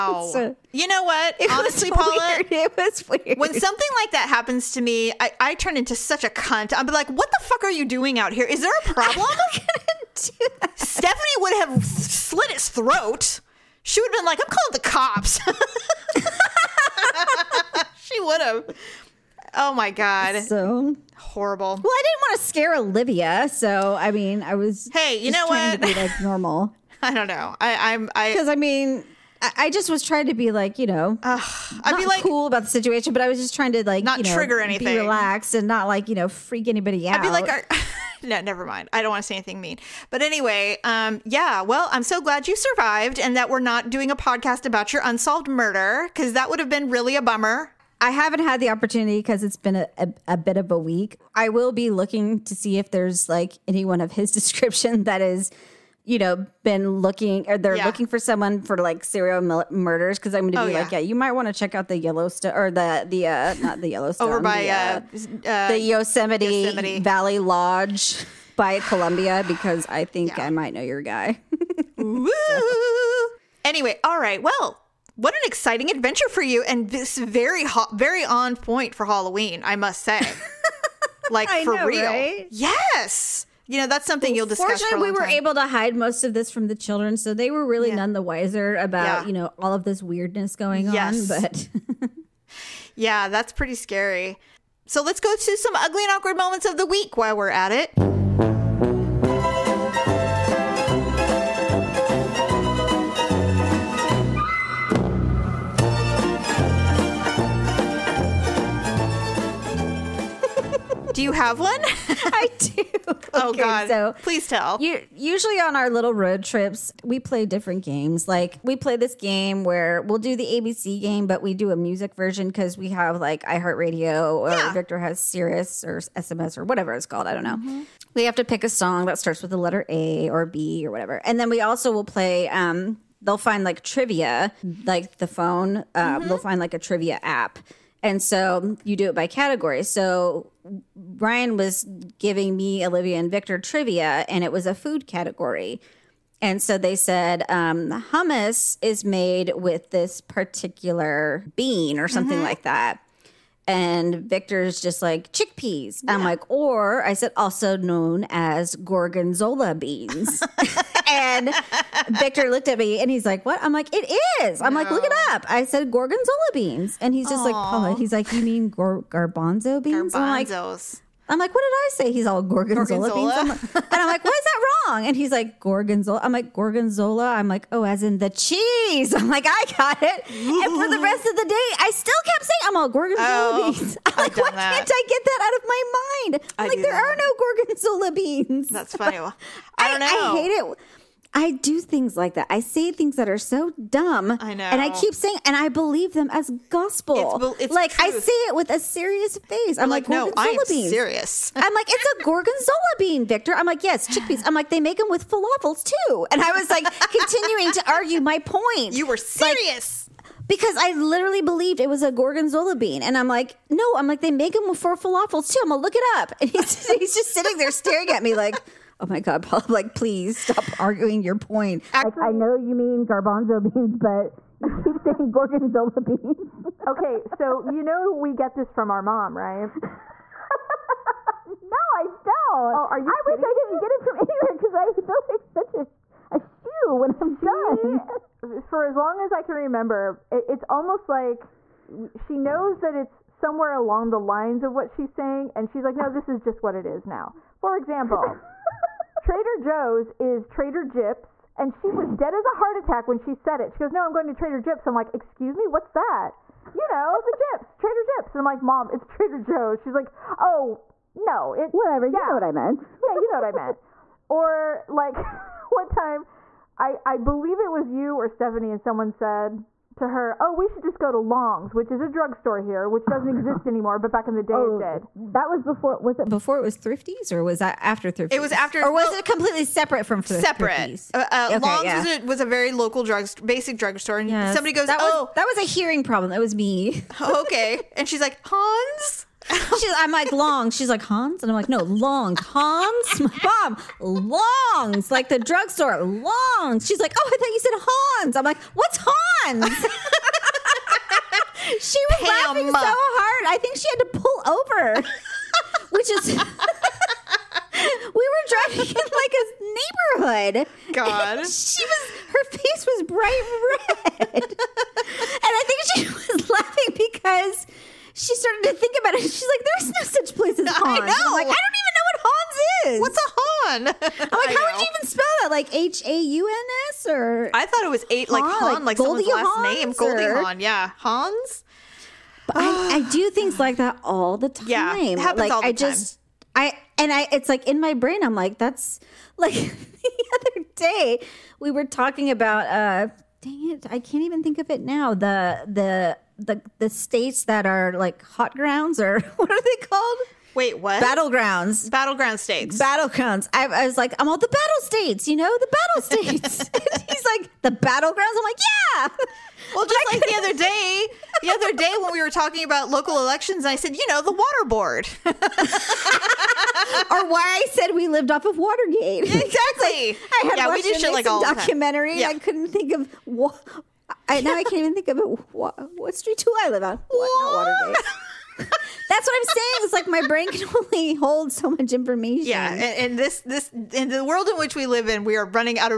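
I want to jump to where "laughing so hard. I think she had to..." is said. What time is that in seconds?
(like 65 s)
302 s.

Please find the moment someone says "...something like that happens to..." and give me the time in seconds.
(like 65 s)
3 s.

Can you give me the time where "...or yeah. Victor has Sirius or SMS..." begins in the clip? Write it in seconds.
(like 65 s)
124 s.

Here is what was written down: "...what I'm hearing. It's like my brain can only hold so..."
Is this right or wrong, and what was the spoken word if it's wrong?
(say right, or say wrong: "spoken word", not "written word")
wrong: "saying", not "hearing".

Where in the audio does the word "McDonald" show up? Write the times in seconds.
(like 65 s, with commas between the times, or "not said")
not said.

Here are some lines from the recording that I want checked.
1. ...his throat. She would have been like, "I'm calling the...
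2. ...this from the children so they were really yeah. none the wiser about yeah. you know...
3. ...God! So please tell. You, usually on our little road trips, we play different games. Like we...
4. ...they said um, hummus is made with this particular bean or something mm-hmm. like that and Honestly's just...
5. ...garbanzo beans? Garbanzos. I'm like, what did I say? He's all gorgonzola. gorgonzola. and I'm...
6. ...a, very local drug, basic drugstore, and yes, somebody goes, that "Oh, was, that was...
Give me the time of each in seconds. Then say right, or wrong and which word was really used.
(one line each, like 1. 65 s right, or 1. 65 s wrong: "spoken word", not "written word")
1. 12 s right
2. 86 s right
3. 113 s right
4. 146 s wrong: "Victor", not "Honestly"
5. 168 s right
6. 282 s right.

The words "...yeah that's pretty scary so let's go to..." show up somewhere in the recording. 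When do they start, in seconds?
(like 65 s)
92 s.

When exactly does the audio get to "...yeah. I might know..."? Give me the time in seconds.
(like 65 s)
70 s.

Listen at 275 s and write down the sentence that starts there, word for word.
Was it before it was Thrifties, or was that after Thrifties?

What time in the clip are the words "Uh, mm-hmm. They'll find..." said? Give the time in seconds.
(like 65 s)
135 s.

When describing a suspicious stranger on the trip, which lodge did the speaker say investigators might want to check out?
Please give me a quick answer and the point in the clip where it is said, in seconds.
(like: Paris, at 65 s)
Yosemite Valley Lodge, at 66 s.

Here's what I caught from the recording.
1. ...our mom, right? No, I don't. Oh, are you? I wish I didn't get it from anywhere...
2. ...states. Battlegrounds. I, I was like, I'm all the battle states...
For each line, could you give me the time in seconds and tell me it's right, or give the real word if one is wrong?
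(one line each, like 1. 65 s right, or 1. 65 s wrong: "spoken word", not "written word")
1. 228 s right
2. 352 s right.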